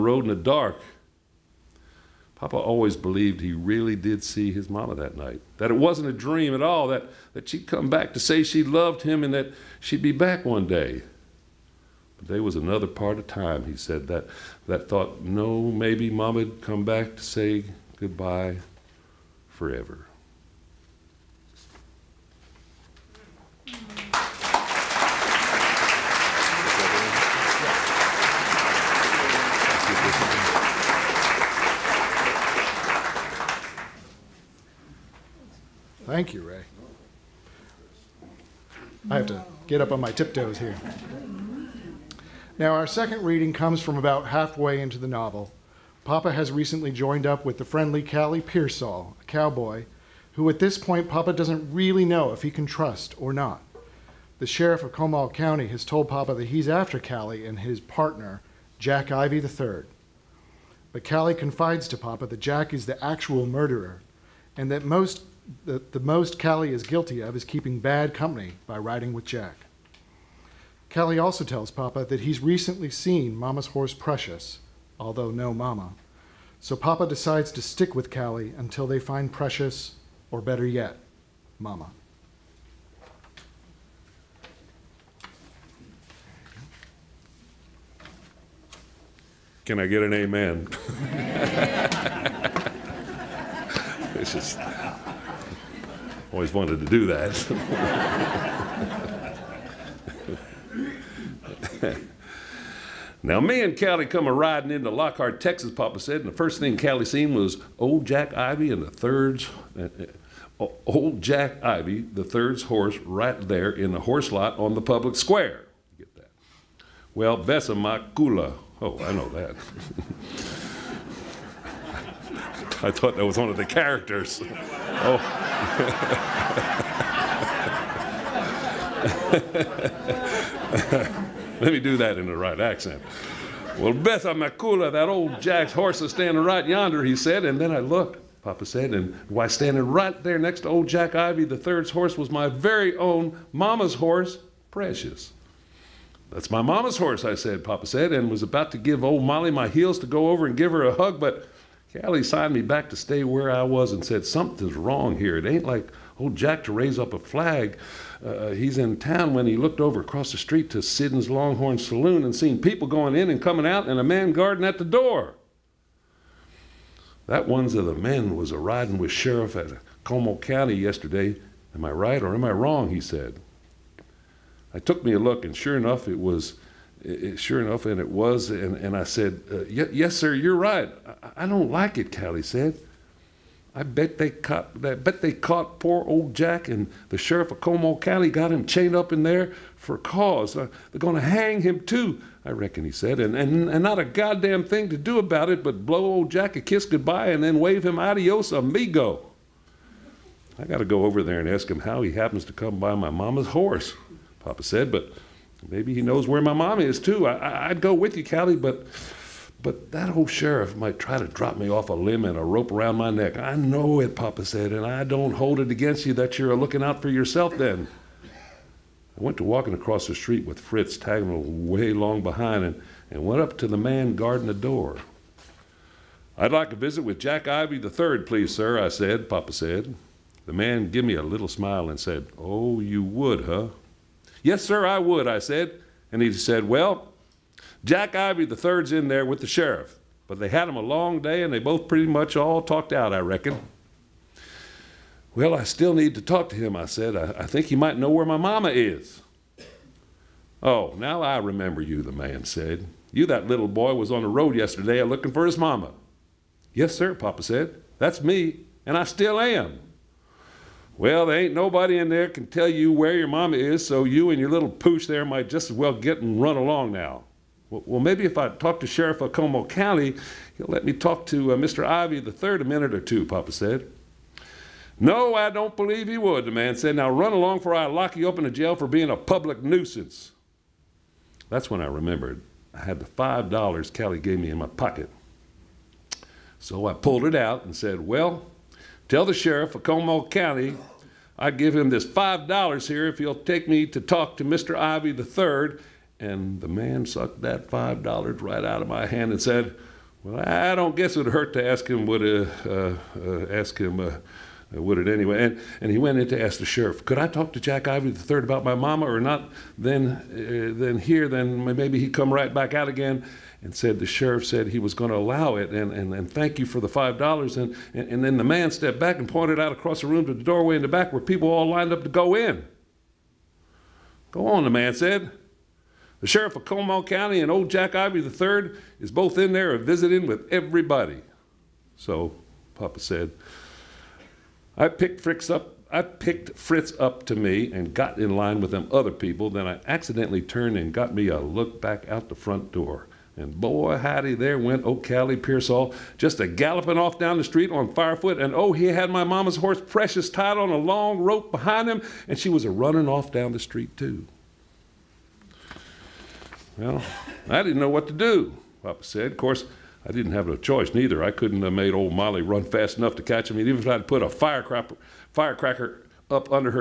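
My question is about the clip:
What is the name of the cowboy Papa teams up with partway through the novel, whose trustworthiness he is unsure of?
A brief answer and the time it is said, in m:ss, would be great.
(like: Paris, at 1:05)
Callie Pearsall, at 0:48.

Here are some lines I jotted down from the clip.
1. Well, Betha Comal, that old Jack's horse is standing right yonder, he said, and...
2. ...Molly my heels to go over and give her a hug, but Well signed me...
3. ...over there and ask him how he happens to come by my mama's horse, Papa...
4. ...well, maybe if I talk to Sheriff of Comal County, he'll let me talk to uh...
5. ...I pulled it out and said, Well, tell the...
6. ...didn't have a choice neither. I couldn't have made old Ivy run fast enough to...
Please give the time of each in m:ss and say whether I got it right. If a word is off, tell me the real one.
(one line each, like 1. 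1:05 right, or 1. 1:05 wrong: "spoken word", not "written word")
1. 2:13 wrong: "Makula", not "Comal"
2. 2:29 wrong: "Callie", not "Well"
3. 3:21 right
4. 4:27 right
5. 4:46 right
6. 6:00 wrong: "Molly", not "Ivy".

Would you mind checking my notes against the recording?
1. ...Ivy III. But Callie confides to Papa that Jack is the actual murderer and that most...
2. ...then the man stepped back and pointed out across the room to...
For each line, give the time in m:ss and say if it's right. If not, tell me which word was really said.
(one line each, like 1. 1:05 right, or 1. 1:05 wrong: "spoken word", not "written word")
1. 0:59 right
2. 5:18 right.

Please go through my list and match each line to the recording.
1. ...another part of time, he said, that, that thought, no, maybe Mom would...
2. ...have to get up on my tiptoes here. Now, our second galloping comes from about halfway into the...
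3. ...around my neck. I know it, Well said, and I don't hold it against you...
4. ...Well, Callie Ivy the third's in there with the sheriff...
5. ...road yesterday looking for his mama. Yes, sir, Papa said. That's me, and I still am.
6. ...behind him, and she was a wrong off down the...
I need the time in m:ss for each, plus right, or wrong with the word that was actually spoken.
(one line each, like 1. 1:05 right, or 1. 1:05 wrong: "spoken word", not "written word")
1. 0:12 right
2. 0:39 wrong: "reading", not "galloping"
3. 3:32 wrong: "Papa", not "Well"
4. 3:56 wrong: "Jack", not "Callie"
5. 4:14 right
6. 5:51 wrong: "running", not "wrong".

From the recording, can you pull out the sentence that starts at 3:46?
I'd like a visit with Jack Ivy the third, please, sir, I said, Papa said.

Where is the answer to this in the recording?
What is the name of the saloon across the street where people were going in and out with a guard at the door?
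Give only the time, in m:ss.
2:40.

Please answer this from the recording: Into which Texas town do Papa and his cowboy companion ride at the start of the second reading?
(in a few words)
Lockhart.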